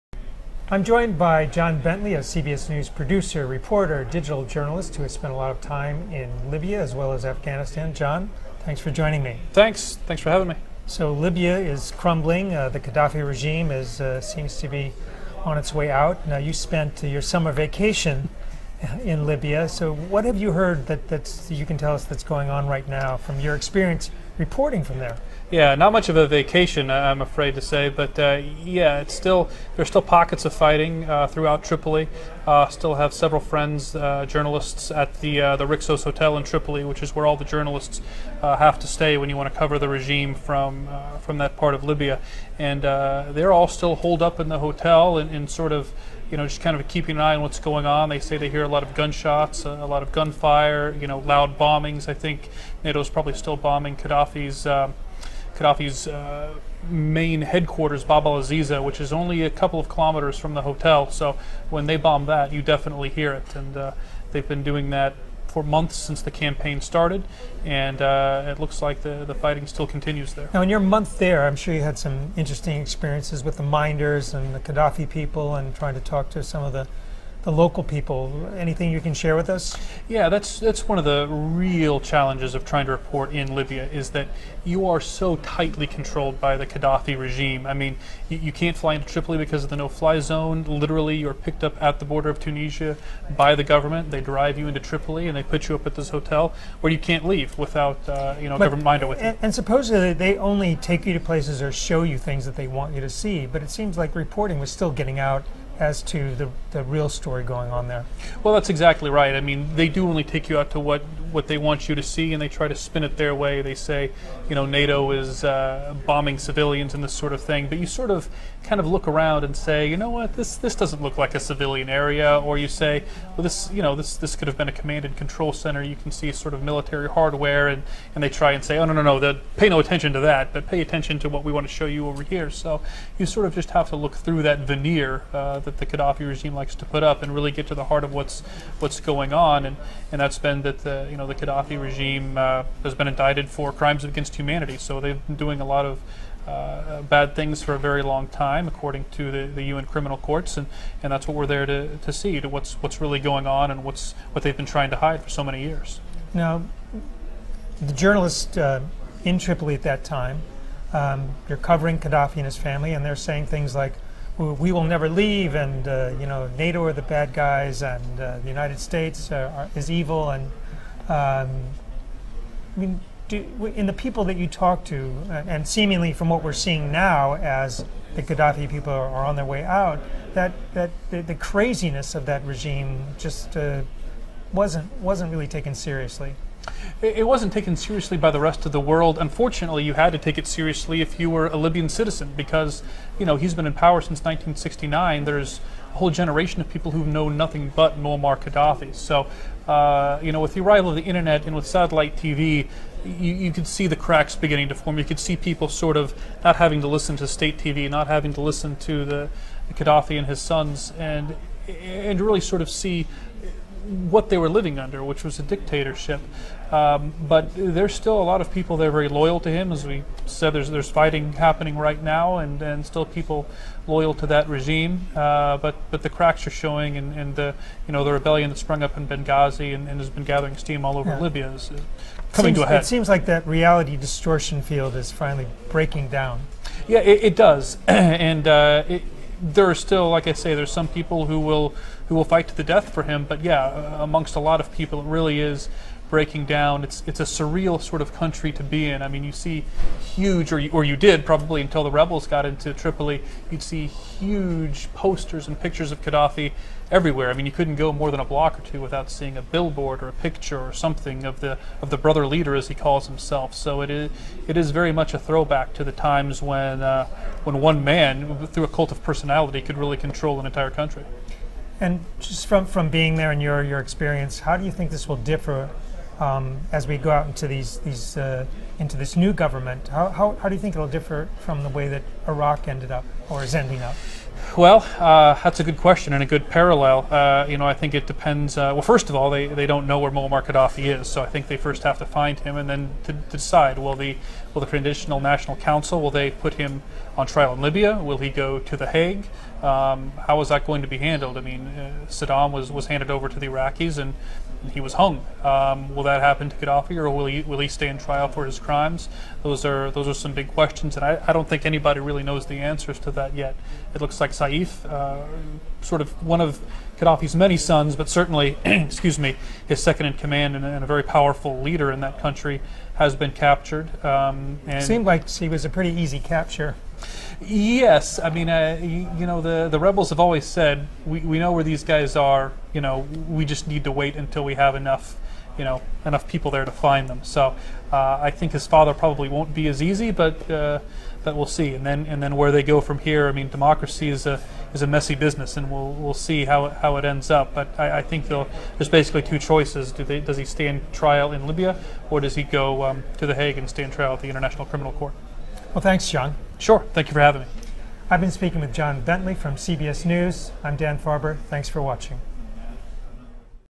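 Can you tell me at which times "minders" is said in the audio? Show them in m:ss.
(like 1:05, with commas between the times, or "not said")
1:13, 1:38.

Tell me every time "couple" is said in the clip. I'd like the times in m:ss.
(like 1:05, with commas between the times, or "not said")
0:59.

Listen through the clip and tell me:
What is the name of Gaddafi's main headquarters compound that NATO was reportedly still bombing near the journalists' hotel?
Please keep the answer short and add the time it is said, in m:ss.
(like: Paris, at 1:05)
Bab al Azizia, at 0:58.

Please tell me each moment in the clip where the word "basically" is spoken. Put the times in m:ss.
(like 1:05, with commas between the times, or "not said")
5:48.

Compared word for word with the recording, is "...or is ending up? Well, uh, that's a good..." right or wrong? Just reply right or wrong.
right.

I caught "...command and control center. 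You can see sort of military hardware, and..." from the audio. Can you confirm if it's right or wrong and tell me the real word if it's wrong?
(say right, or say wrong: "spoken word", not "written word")
right.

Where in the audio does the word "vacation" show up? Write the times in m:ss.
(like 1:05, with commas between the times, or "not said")
0:17, 0:26.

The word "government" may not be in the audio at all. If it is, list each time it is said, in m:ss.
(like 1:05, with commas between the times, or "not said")
1:33, 1:38, 4:39.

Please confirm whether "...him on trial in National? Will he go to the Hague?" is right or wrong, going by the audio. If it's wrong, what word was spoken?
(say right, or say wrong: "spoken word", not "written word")
wrong: "Libya", not "National".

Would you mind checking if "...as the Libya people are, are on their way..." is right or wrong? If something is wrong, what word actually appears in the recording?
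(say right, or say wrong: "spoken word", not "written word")
wrong: "Gaddafi", not "Libya".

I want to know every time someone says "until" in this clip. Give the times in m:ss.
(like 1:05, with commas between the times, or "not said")
4:11, 5:34.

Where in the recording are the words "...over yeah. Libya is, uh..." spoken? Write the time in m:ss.
3:50.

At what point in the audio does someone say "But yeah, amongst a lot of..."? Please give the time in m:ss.
4:03.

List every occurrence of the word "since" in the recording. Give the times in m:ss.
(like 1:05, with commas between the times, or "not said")
1:05, 3:14.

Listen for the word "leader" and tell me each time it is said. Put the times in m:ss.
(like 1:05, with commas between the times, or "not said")
4:22, 5:21.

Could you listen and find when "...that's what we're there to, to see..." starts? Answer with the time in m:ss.
2:31.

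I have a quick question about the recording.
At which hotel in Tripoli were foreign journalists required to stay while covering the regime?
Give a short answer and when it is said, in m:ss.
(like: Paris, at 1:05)
Rixos Hotel, at 0:35.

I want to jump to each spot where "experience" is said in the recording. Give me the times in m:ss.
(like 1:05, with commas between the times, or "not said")
0:23, 1:12, 4:33.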